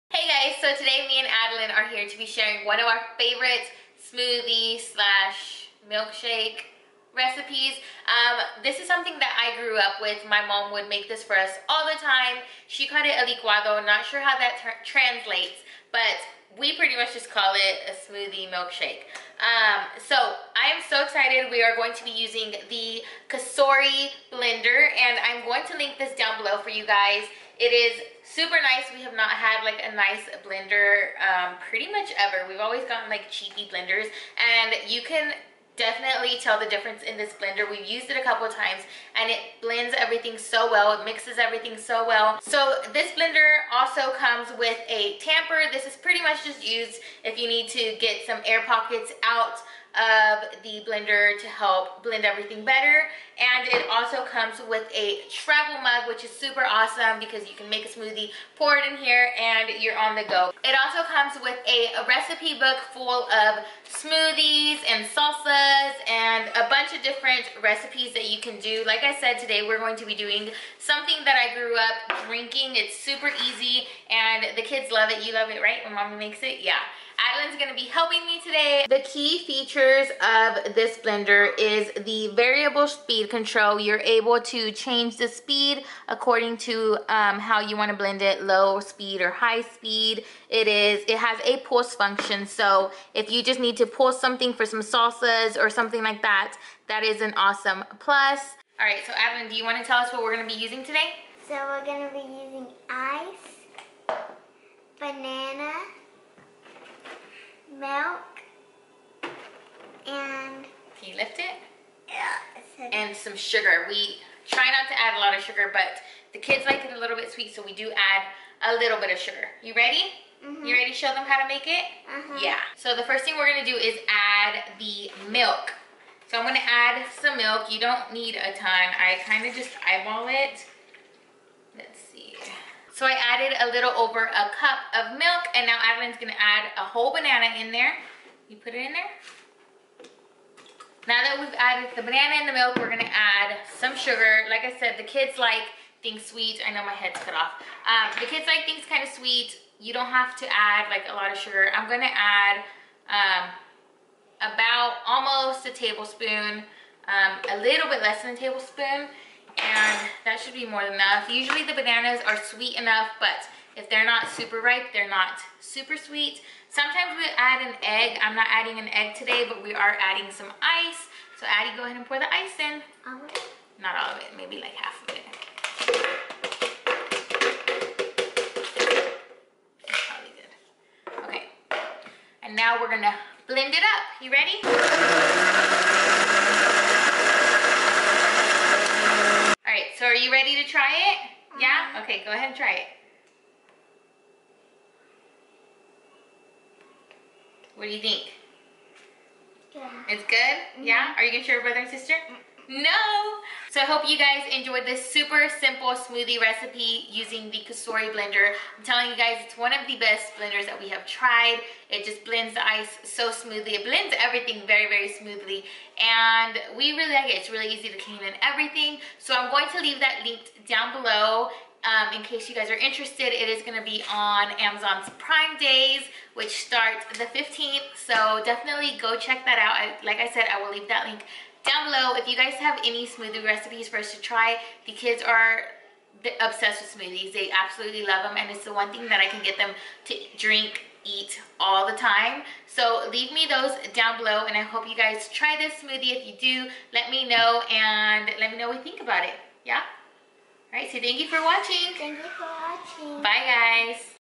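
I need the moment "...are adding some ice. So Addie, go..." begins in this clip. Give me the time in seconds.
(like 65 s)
169 s.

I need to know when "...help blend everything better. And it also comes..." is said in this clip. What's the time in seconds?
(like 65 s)
51 s.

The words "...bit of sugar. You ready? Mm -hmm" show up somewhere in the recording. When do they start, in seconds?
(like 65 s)
118 s.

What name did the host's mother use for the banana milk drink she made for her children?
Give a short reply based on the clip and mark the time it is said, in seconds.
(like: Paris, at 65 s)
licuado, at 13 s.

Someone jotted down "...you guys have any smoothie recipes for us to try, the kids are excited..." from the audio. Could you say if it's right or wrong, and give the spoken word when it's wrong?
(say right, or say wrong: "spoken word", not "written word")
wrong: "obsessed", not "excited".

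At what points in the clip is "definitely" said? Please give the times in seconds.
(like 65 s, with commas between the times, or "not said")
35 s, 228 s.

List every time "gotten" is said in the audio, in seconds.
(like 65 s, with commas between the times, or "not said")
32 s.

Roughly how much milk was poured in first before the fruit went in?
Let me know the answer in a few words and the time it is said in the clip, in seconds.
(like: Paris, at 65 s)
a little over a cup, at 133 s.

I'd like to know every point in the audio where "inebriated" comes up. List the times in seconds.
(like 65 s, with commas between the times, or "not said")
not said.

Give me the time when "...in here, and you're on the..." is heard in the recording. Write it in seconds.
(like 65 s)
58 s.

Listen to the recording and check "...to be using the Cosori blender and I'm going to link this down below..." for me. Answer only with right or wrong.
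right.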